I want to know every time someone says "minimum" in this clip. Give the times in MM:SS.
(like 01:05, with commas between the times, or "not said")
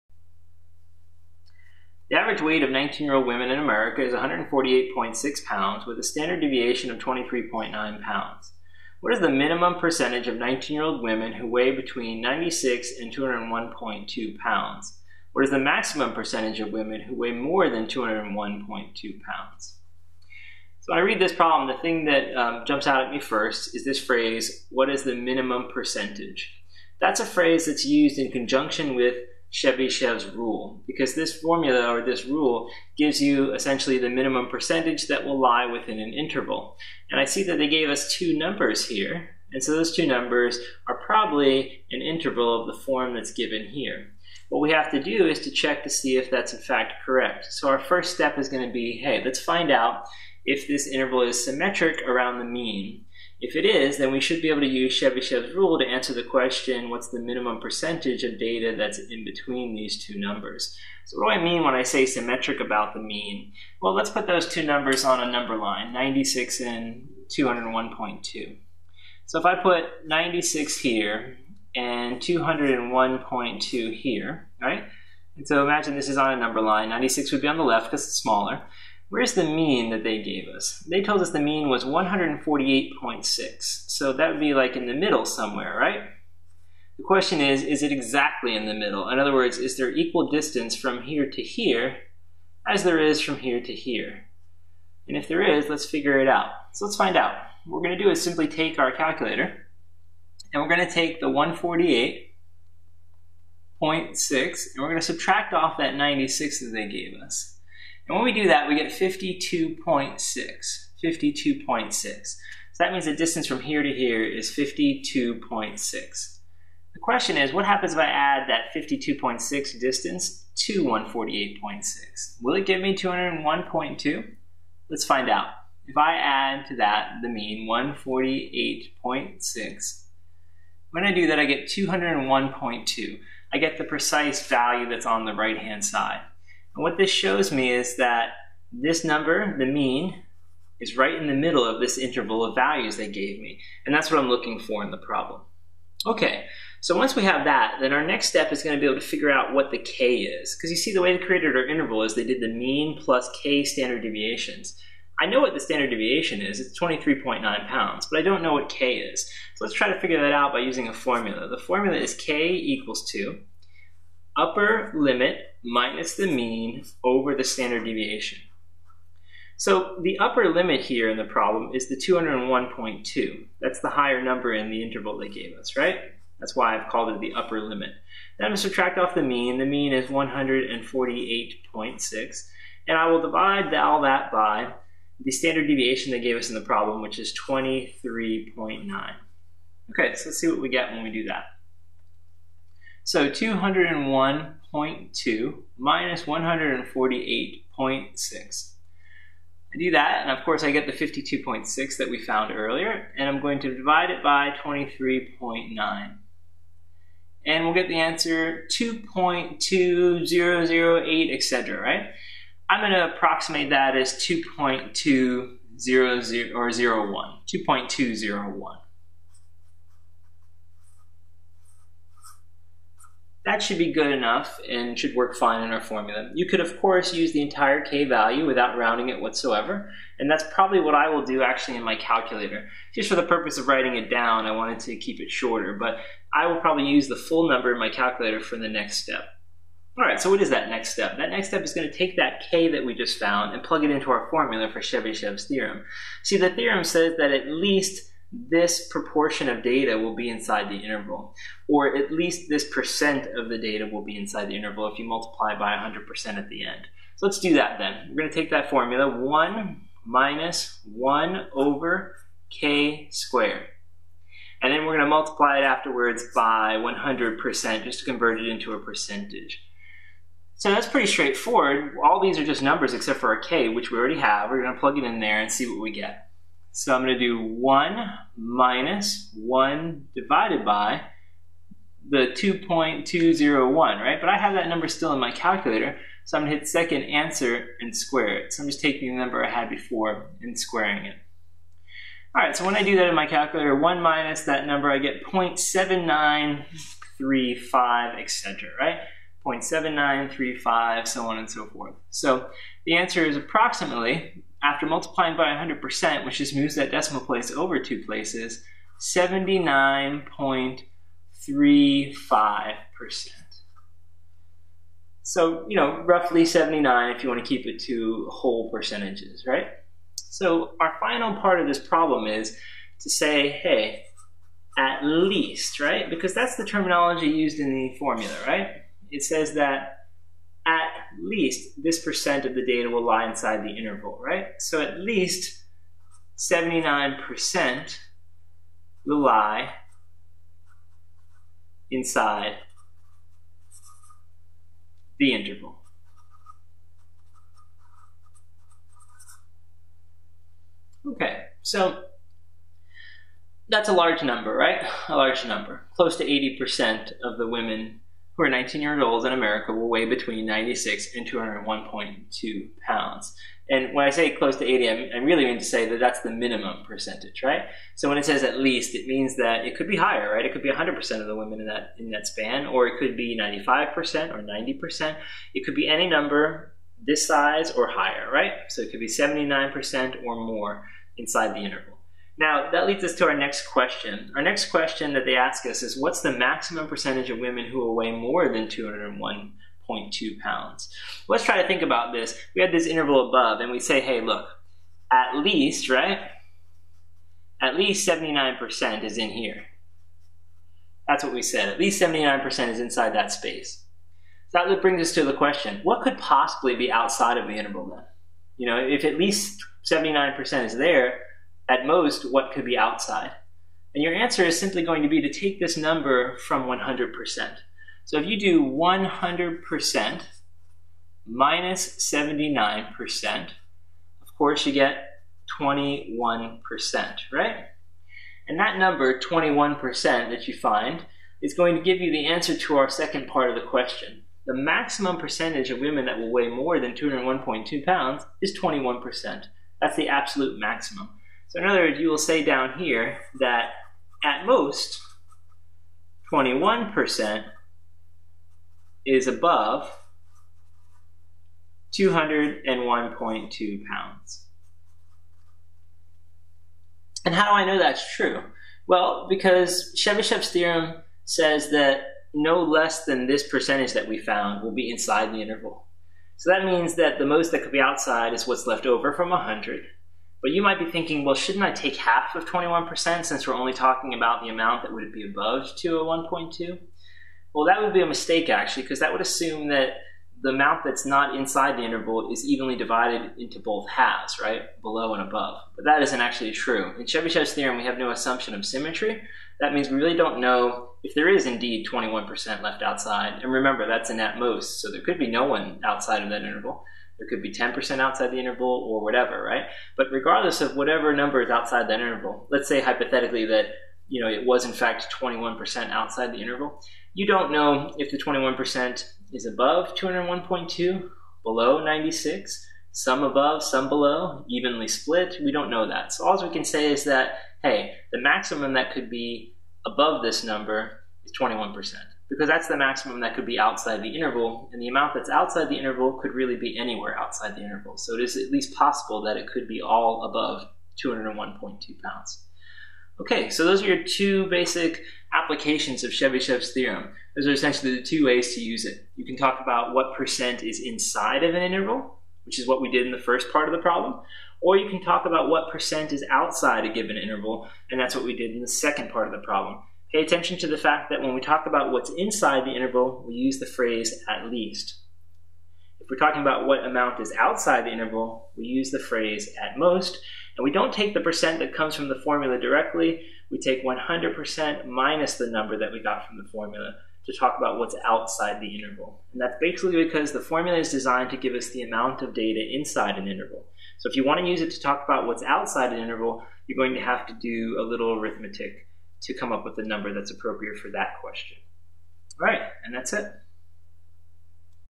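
00:09, 00:25, 00:34, 00:57, 06:06.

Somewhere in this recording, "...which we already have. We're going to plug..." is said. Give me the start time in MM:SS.
04:33.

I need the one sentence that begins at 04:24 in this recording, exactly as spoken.
And then we're going to multiply it afterwards by 100% just to convert it into a percentage.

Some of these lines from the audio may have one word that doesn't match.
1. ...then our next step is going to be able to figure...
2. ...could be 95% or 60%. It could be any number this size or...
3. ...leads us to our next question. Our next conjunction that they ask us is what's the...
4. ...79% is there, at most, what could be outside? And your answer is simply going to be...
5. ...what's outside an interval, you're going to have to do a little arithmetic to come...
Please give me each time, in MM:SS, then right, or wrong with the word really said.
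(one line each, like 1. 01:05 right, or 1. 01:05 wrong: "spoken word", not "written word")
1. 02:27 right
2. 06:12 wrong: "90", not "60"
3. 06:22 wrong: "question", not "conjunction"
4. 06:49 right
5. 09:35 right.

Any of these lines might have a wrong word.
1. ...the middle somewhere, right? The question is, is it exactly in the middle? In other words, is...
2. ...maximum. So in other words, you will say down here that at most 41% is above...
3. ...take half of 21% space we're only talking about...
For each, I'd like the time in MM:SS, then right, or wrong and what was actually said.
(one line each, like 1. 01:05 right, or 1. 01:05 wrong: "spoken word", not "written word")
1. 01:24 right
2. 07:20 wrong: "21", not "41"
3. 07:51 wrong: "since", not "space".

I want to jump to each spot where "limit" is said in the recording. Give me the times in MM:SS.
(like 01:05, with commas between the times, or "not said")
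02:44, 02:50, 02:57.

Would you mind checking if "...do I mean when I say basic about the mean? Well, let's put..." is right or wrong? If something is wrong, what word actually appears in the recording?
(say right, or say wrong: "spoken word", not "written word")
wrong: "symmetric", not "basic".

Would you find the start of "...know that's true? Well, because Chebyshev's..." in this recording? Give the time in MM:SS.
07:37.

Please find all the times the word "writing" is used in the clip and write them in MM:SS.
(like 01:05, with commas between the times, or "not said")
03:53.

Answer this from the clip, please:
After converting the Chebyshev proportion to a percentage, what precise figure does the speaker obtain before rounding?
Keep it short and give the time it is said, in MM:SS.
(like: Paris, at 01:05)
79.35%, at 05:09.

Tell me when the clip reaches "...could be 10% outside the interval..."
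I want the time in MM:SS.
08:17.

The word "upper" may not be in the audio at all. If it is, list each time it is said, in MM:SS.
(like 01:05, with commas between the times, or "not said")
02:44, 02:50, 02:57.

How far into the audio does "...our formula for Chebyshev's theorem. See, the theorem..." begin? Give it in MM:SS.
04:04.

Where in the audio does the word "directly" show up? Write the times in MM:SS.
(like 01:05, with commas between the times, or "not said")
09:22.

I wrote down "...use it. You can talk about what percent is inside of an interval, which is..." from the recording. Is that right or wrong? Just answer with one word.
right.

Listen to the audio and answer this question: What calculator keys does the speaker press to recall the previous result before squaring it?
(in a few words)
second answer.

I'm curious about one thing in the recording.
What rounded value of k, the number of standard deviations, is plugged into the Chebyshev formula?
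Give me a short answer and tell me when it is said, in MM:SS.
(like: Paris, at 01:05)
2.201, at 04:42.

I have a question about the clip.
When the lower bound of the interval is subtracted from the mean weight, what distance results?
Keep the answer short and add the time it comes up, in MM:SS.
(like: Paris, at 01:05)
52.6, at 01:48.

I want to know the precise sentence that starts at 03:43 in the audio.
That should be good enough and should work fine in our formula.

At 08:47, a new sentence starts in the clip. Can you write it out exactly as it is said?
So it is at least possible that it could be all above 201.2 pounds.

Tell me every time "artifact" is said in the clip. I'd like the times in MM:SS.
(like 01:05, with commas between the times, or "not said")
not said.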